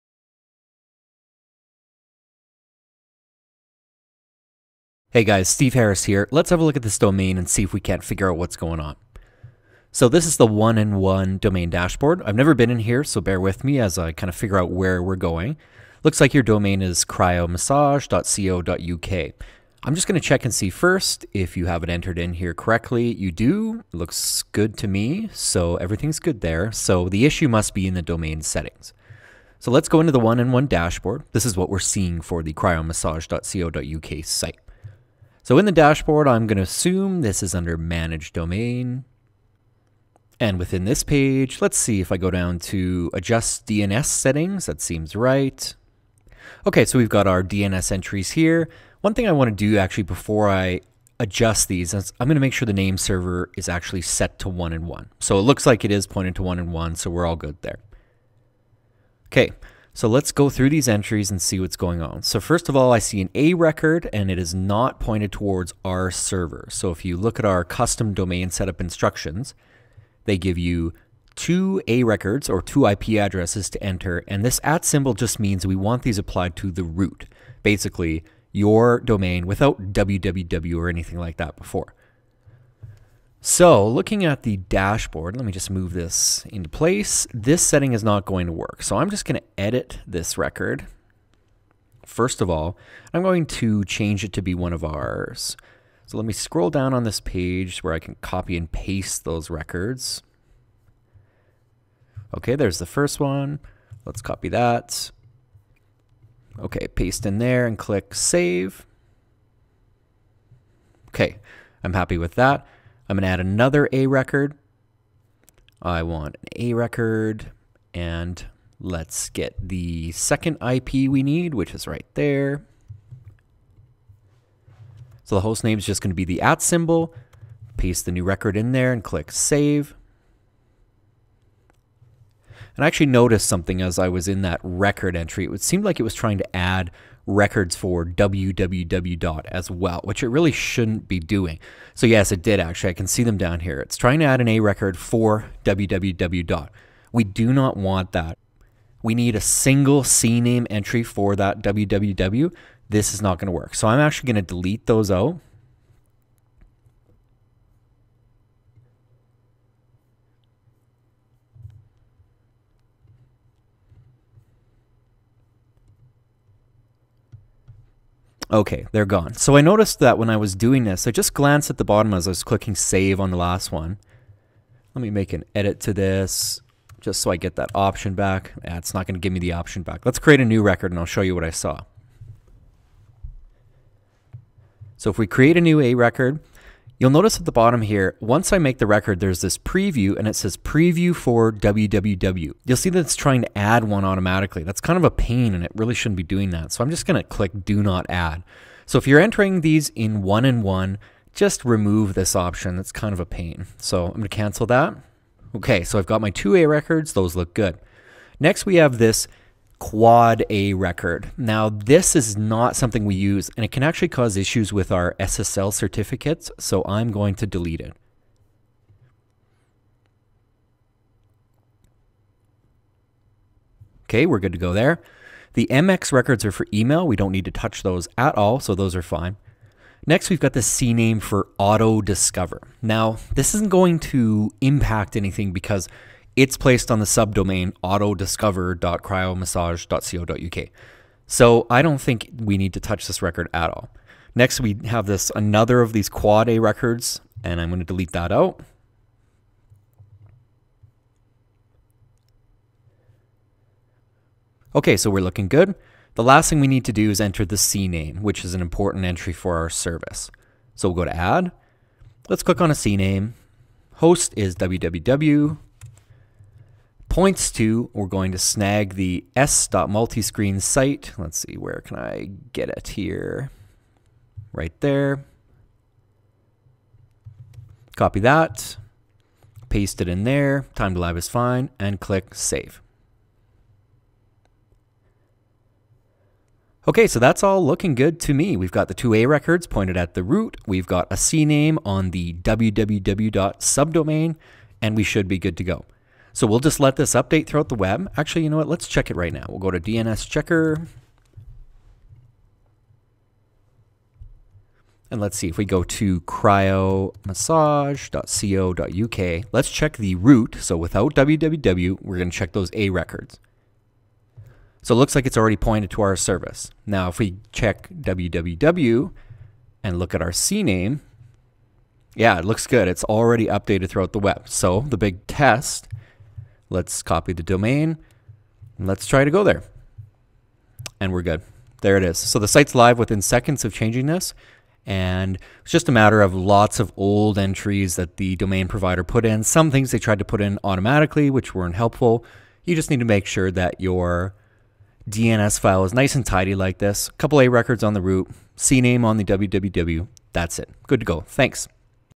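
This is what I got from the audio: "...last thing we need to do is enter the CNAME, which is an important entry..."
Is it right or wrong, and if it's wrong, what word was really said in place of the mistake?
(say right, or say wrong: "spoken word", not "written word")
right.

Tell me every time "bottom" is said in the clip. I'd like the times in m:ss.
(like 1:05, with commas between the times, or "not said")
2:51, 3:07.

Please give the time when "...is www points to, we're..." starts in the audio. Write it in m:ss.
4:24.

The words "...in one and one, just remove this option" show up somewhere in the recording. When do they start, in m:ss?
3:19.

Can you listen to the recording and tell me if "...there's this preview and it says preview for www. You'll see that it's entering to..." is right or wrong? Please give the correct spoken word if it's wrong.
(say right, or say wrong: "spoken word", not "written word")
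wrong: "trying", not "entering".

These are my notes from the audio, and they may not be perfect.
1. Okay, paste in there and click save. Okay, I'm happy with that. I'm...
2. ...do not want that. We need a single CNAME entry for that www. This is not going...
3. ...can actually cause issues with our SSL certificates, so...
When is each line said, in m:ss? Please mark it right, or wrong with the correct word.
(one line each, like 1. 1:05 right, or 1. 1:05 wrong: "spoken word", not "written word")
1. 1:46 right
2. 2:27 right
3. 3:33 right.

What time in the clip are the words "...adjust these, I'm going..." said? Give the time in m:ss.
0:51.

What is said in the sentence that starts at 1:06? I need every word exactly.
So if you look at our custom domain setup instructions, they give you two A records or two IP addresses to enter.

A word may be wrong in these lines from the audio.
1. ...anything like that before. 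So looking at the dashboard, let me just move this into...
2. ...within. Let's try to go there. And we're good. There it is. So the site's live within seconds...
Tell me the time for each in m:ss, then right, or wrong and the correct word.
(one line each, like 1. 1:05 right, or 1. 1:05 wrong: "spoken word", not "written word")
1. 1:20 right
2. 5:27 wrong: "domain", not "within".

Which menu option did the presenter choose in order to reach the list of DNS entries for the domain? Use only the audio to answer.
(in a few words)
Adjust DNS Settings.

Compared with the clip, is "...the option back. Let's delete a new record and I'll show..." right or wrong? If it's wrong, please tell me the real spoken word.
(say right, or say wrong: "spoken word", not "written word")
wrong: "create", not "delete".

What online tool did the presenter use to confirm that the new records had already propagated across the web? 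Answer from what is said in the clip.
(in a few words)
DNS checker.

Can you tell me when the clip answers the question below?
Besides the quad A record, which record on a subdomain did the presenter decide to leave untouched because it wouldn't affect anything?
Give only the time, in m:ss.
3:51.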